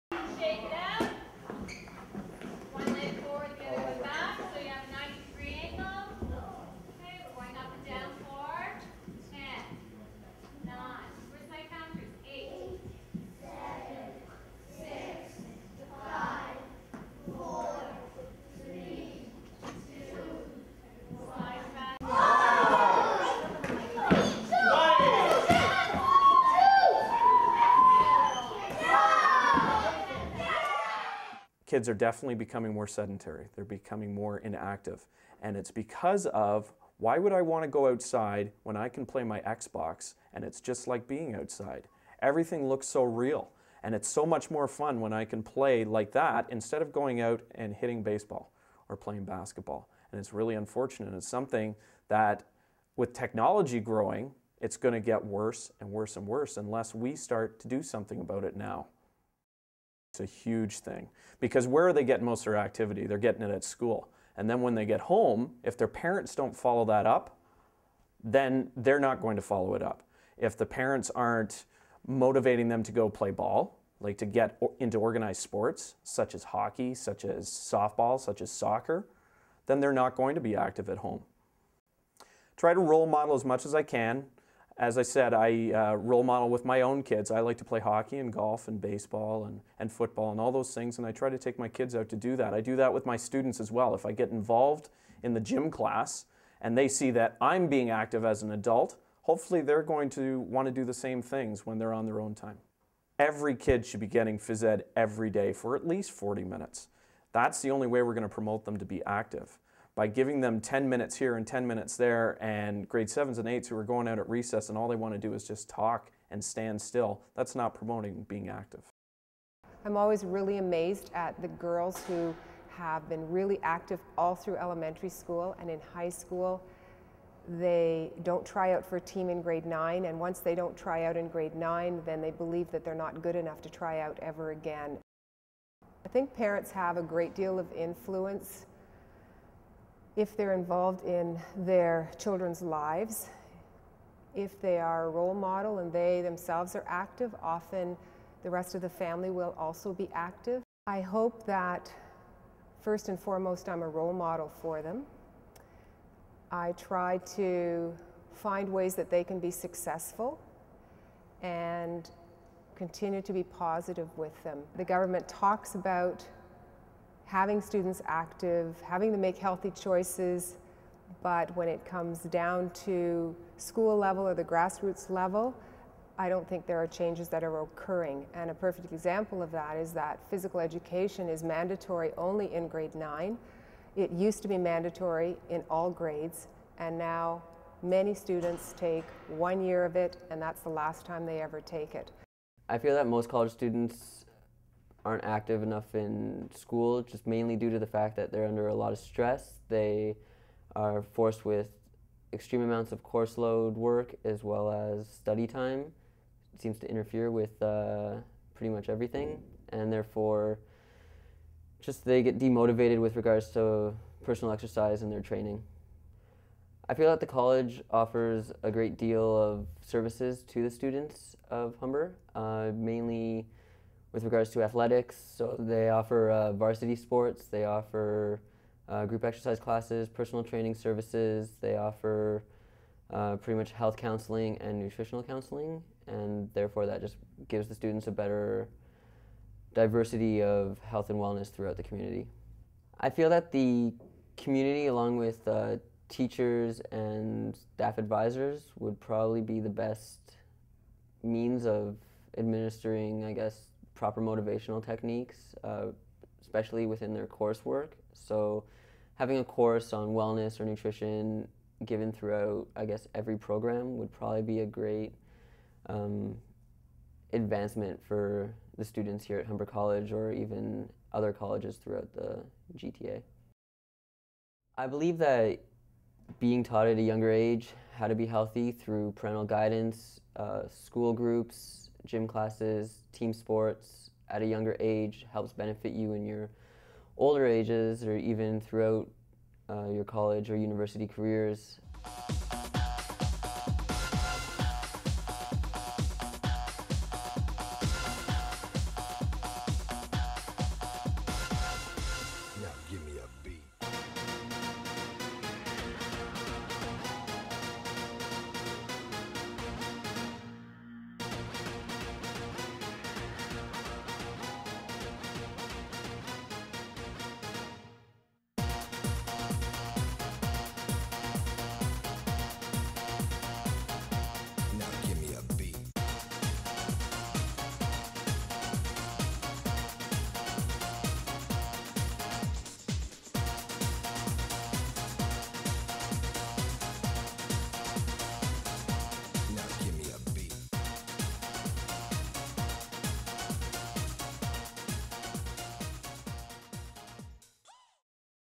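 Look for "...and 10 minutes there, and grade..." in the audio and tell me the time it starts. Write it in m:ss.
1:51.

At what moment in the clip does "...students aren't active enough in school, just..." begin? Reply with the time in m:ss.
3:13.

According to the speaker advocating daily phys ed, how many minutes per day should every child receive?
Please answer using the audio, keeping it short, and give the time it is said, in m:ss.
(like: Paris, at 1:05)
40, at 1:46.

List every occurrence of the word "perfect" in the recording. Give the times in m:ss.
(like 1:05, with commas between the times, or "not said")
2:58.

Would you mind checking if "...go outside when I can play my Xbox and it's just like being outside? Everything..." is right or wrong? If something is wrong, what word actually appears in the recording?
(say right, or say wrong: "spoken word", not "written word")
right.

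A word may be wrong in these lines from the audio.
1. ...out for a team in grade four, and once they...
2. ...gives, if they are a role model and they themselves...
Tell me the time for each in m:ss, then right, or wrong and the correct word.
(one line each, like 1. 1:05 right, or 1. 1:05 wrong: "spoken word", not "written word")
1. 2:08 wrong: "nine", not "four"
2. 2:22 wrong: "lives", not "gives".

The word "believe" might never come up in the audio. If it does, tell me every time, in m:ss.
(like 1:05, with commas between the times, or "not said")
2:12, 4:34.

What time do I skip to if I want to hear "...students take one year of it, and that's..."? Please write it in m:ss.
3:08.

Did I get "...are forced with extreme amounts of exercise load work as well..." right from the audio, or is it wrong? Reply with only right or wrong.
wrong.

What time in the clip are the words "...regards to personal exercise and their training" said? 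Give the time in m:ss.
3:33.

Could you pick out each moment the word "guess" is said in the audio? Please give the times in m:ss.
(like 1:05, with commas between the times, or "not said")
4:13, 4:22.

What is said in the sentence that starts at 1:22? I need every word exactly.
Try to role model as much as I can as I said, I uh, role model with my own kids.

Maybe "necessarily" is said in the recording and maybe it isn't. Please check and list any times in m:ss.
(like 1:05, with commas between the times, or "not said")
not said.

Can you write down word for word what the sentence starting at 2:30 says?
I hope that first and foremost I'm a role model for them.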